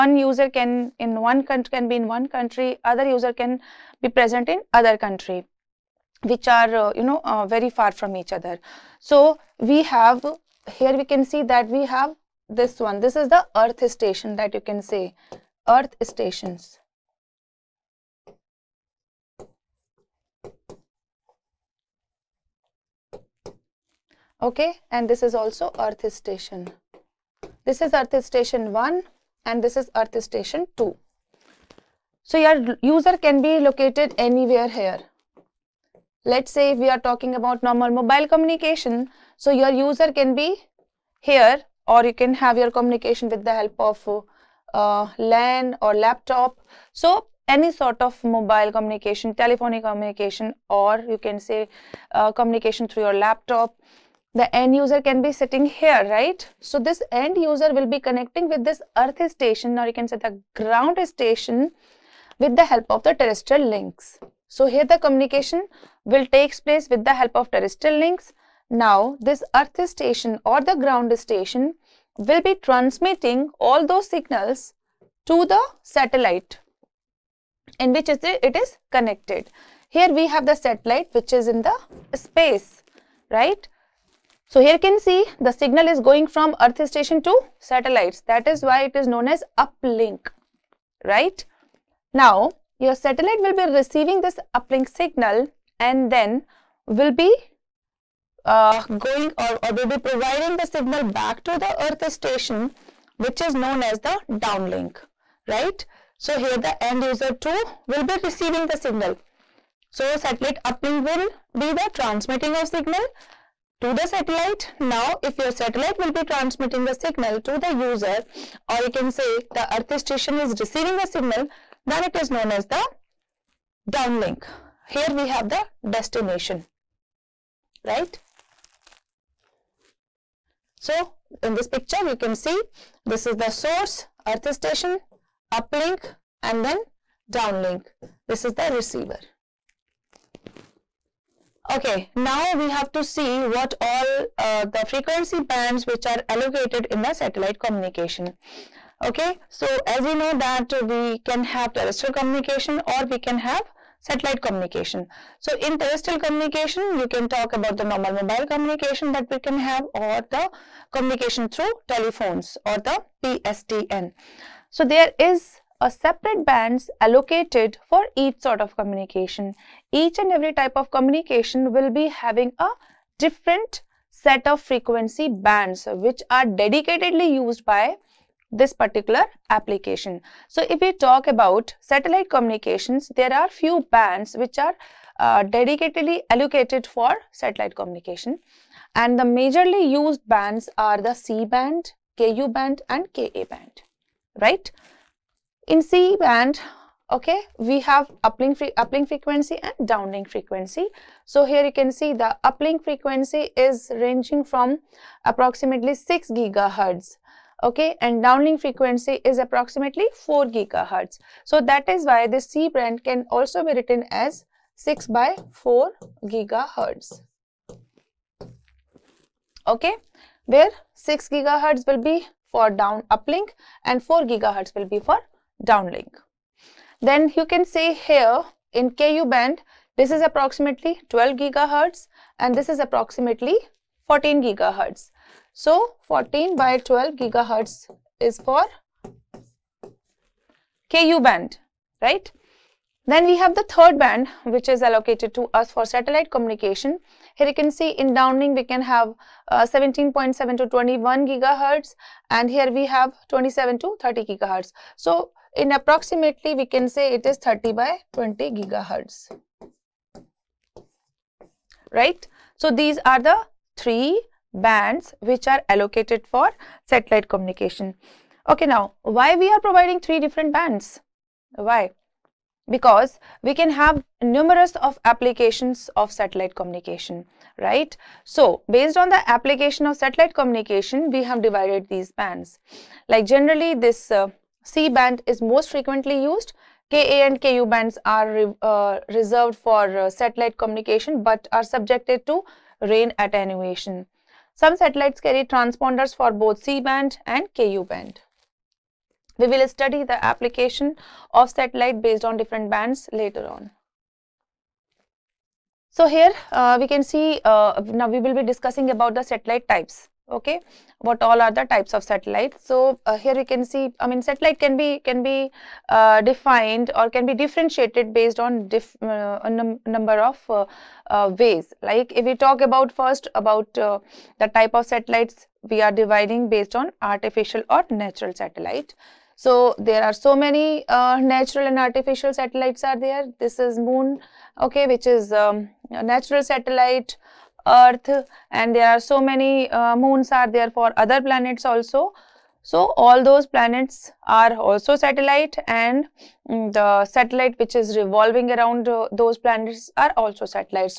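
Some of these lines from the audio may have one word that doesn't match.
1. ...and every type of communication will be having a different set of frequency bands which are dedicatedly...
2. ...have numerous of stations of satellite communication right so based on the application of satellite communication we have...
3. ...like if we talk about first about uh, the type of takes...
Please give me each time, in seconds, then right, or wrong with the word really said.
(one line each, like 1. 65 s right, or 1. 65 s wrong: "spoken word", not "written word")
1. 170 s right
2. 273 s wrong: "applications", not "stations"
3. 321 s wrong: "satellites", not "takes".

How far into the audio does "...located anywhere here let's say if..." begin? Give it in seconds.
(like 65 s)
33 s.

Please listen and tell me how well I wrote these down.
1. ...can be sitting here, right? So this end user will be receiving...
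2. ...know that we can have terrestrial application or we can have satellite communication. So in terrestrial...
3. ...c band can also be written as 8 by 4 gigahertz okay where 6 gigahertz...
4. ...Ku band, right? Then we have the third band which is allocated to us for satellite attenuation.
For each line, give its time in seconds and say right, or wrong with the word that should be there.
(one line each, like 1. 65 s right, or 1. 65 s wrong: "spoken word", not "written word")
1. 55 s wrong: "connecting", not "receiving"
2. 150 s wrong: "communication", not "application"
3. 212 s wrong: "6", not "8"
4. 240 s wrong: "communication", not "attenuation".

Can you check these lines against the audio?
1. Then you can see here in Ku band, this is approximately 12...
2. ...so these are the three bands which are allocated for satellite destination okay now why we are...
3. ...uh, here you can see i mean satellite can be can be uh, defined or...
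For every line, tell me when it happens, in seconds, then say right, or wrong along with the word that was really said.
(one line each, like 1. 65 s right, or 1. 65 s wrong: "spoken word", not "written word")
1. 227 s right
2. 262 s wrong: "communication", not "destination"
3. 313 s right.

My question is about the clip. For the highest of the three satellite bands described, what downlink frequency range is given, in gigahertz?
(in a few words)
17.7 to 21 GHz.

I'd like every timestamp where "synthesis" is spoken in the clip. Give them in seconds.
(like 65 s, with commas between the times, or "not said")
not said.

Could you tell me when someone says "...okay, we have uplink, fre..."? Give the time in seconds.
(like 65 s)
197 s.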